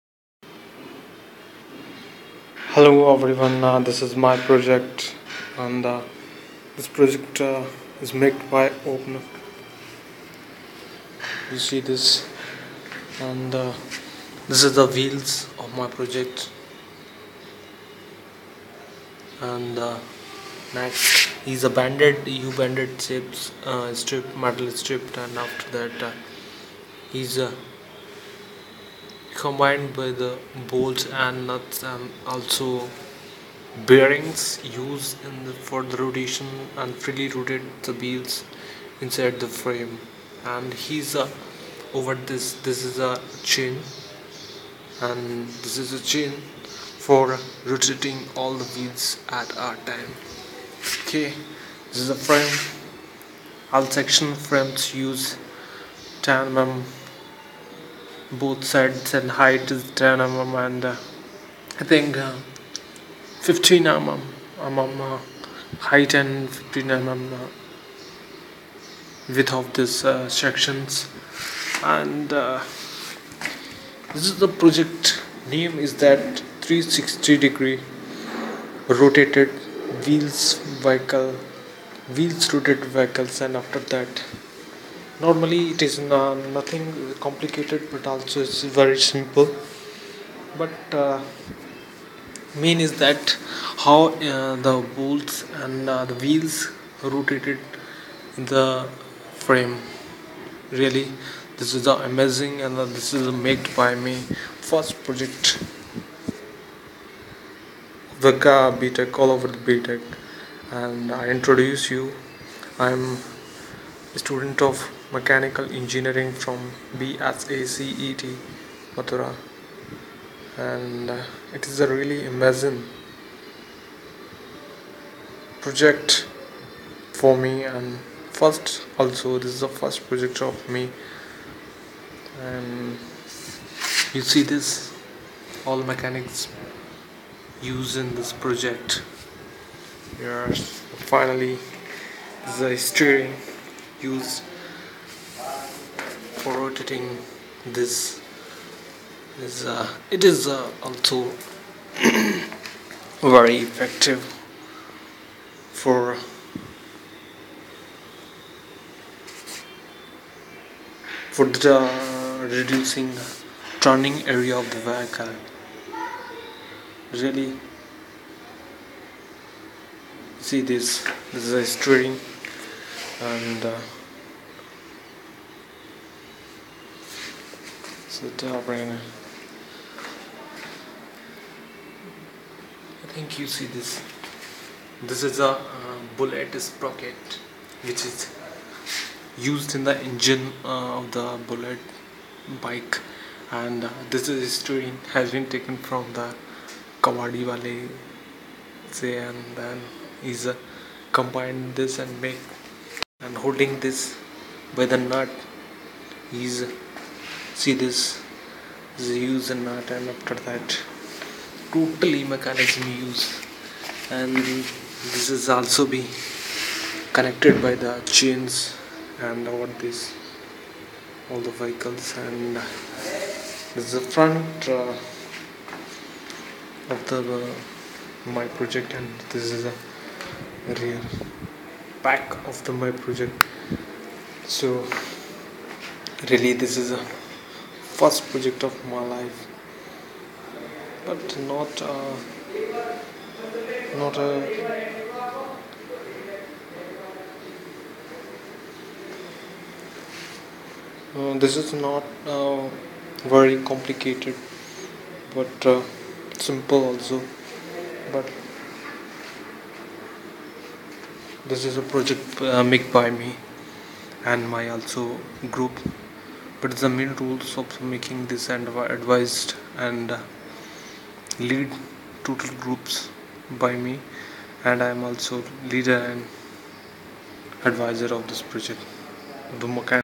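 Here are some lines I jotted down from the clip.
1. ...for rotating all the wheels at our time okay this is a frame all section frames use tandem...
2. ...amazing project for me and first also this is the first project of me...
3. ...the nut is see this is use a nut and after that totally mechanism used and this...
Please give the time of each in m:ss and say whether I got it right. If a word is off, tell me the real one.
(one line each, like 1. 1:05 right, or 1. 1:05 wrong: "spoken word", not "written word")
1. 0:47 right
2. 2:02 right
3. 3:24 right.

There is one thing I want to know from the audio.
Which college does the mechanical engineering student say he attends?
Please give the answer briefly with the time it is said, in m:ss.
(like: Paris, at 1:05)
BSACET Mathura, at 1:56.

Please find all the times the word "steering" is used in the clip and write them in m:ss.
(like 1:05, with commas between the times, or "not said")
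2:22, 2:51.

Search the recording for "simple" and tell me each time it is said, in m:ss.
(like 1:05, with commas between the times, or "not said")
1:29, 4:16.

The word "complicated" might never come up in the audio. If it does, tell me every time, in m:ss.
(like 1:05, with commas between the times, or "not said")
1:27, 4:13.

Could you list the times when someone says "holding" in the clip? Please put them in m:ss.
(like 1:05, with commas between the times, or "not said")
3:23.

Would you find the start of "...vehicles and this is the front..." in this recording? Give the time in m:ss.
3:41.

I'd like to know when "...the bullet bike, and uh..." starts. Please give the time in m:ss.
3:11.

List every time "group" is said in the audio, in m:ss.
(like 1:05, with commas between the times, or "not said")
4:25, 4:32.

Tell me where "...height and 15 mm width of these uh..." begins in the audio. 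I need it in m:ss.
1:05.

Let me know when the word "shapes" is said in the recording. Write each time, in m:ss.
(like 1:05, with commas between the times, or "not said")
0:23.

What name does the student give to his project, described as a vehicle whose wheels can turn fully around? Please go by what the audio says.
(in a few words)
360 degree rotated wheels vehicle.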